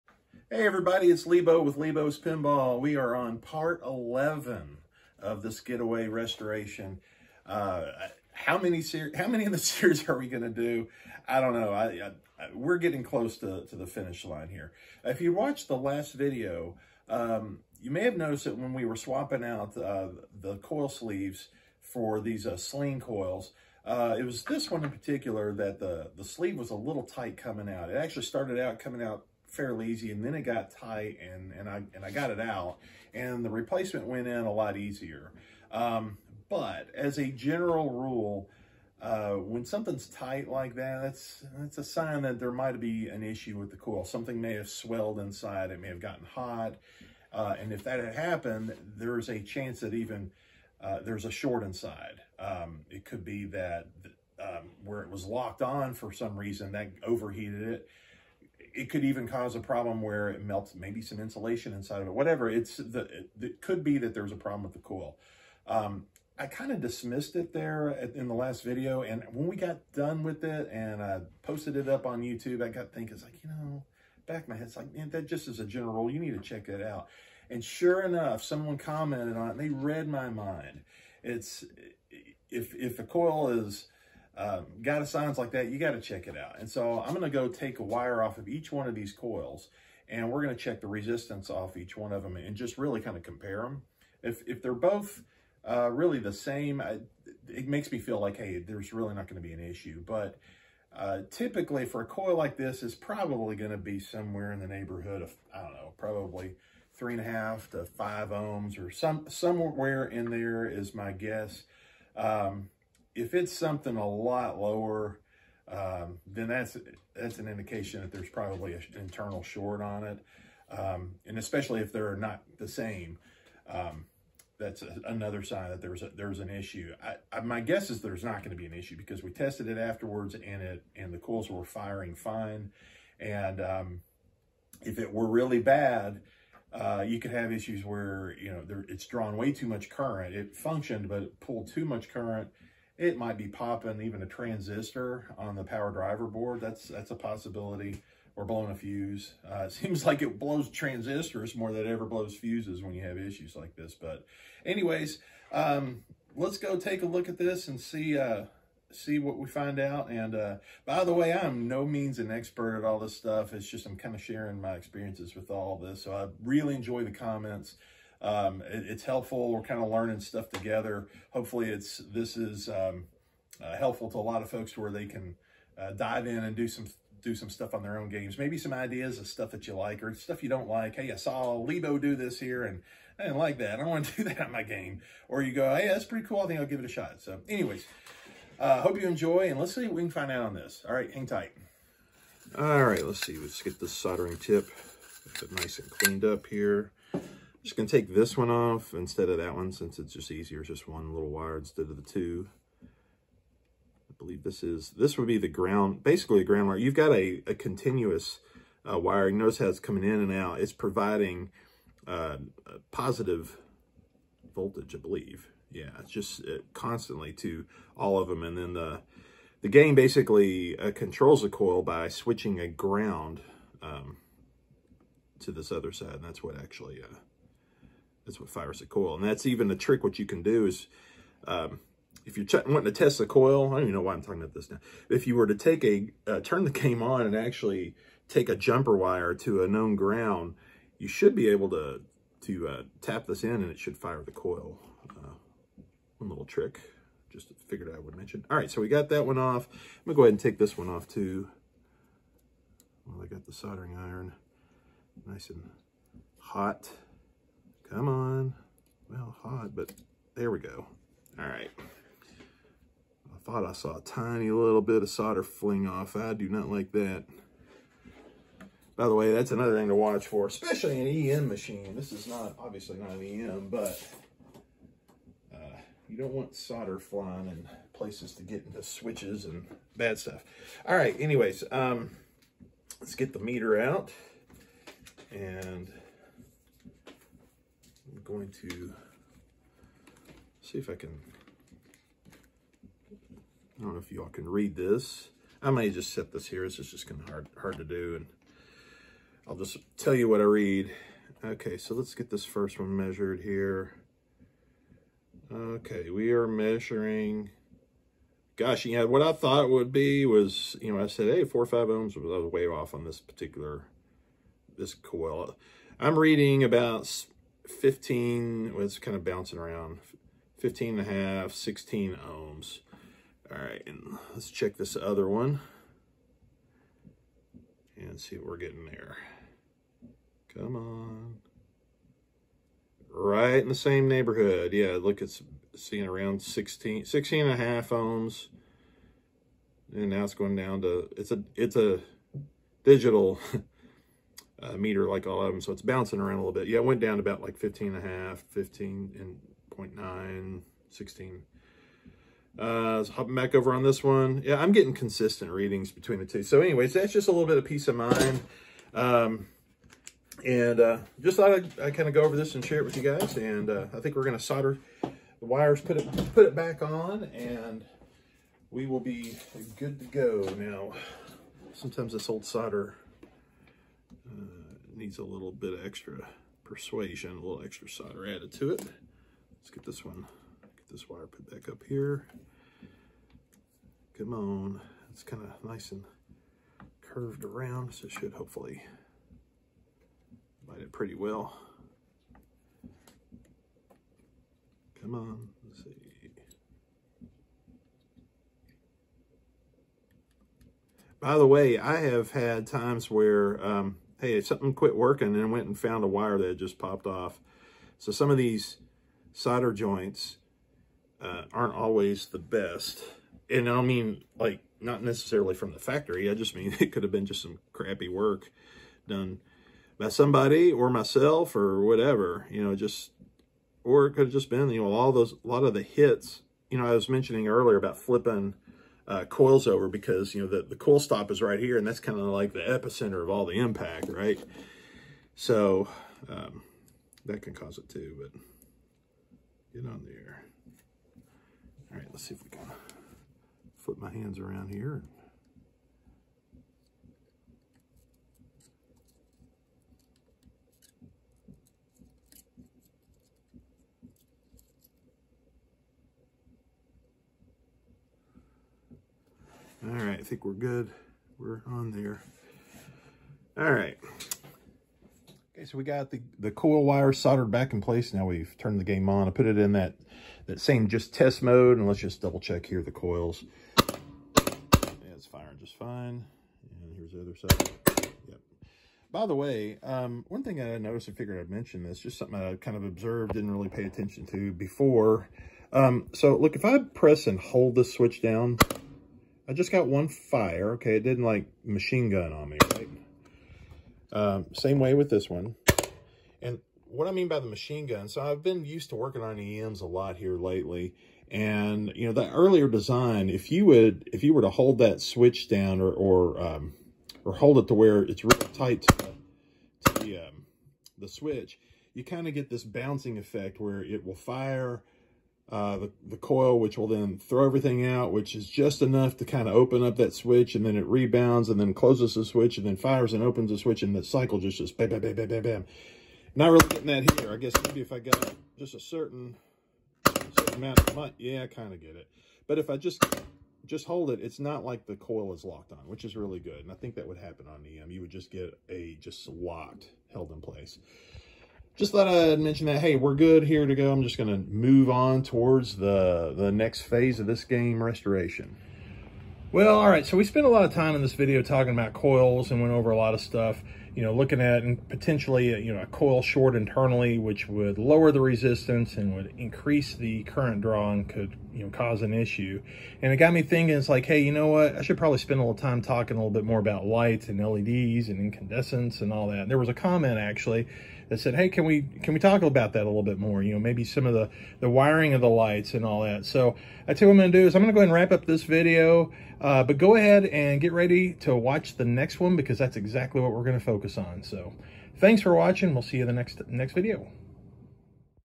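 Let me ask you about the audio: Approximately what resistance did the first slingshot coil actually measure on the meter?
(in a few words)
15.5 to 16 ohms.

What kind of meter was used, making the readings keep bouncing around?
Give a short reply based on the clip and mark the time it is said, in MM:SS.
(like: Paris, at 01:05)
digital, at 05:42.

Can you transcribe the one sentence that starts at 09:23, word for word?
And it got me thinking, it's like, hey, you know what?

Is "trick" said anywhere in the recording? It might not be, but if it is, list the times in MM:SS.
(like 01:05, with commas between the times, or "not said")
03:49, 04:06.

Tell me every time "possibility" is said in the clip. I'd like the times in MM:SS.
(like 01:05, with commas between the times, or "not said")
02:27.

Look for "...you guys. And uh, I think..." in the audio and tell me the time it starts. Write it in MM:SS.
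06:02.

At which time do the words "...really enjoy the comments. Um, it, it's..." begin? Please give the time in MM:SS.
02:46.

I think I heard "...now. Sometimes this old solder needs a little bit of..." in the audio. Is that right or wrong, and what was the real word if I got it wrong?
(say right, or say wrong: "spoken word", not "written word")
right.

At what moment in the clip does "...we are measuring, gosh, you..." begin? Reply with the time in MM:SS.
05:06.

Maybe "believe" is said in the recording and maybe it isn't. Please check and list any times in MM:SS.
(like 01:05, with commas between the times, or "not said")
03:24, 03:34.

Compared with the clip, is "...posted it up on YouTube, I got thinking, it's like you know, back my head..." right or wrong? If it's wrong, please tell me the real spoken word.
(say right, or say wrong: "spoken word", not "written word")
right.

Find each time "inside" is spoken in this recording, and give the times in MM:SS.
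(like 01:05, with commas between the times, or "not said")
00:45, 00:51, 01:01.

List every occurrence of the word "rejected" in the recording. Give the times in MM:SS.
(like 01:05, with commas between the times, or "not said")
not said.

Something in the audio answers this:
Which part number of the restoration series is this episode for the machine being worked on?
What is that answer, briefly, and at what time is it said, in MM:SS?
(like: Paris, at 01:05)
11, at 00:03.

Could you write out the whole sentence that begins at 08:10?
Okay, it didn't like machine gun on me, right?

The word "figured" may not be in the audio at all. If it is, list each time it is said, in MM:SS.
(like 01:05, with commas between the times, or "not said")
04:07, 08:01.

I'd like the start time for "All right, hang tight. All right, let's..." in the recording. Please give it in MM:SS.
03:10.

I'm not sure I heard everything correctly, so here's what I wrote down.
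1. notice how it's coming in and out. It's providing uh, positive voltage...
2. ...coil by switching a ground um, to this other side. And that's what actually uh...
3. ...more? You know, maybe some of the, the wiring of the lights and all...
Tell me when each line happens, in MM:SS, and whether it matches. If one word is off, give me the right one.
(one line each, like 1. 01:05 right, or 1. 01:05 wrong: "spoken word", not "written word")
1. 03:29 right
2. 03:41 right
3. 09:33 right.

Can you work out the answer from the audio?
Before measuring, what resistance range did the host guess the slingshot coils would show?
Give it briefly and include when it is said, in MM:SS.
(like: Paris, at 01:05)
3.5 to 5 ohms, at 01:46.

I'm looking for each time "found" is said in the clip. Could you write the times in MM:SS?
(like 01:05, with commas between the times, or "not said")
06:45.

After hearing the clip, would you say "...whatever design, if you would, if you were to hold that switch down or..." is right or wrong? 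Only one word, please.
wrong.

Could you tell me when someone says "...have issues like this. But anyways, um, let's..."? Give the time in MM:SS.
02:33.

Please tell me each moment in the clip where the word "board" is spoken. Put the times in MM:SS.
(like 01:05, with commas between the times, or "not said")
02:26.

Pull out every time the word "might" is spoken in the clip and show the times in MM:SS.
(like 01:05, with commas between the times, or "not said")
00:42, 02:23.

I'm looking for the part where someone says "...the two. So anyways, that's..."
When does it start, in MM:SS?
05:56.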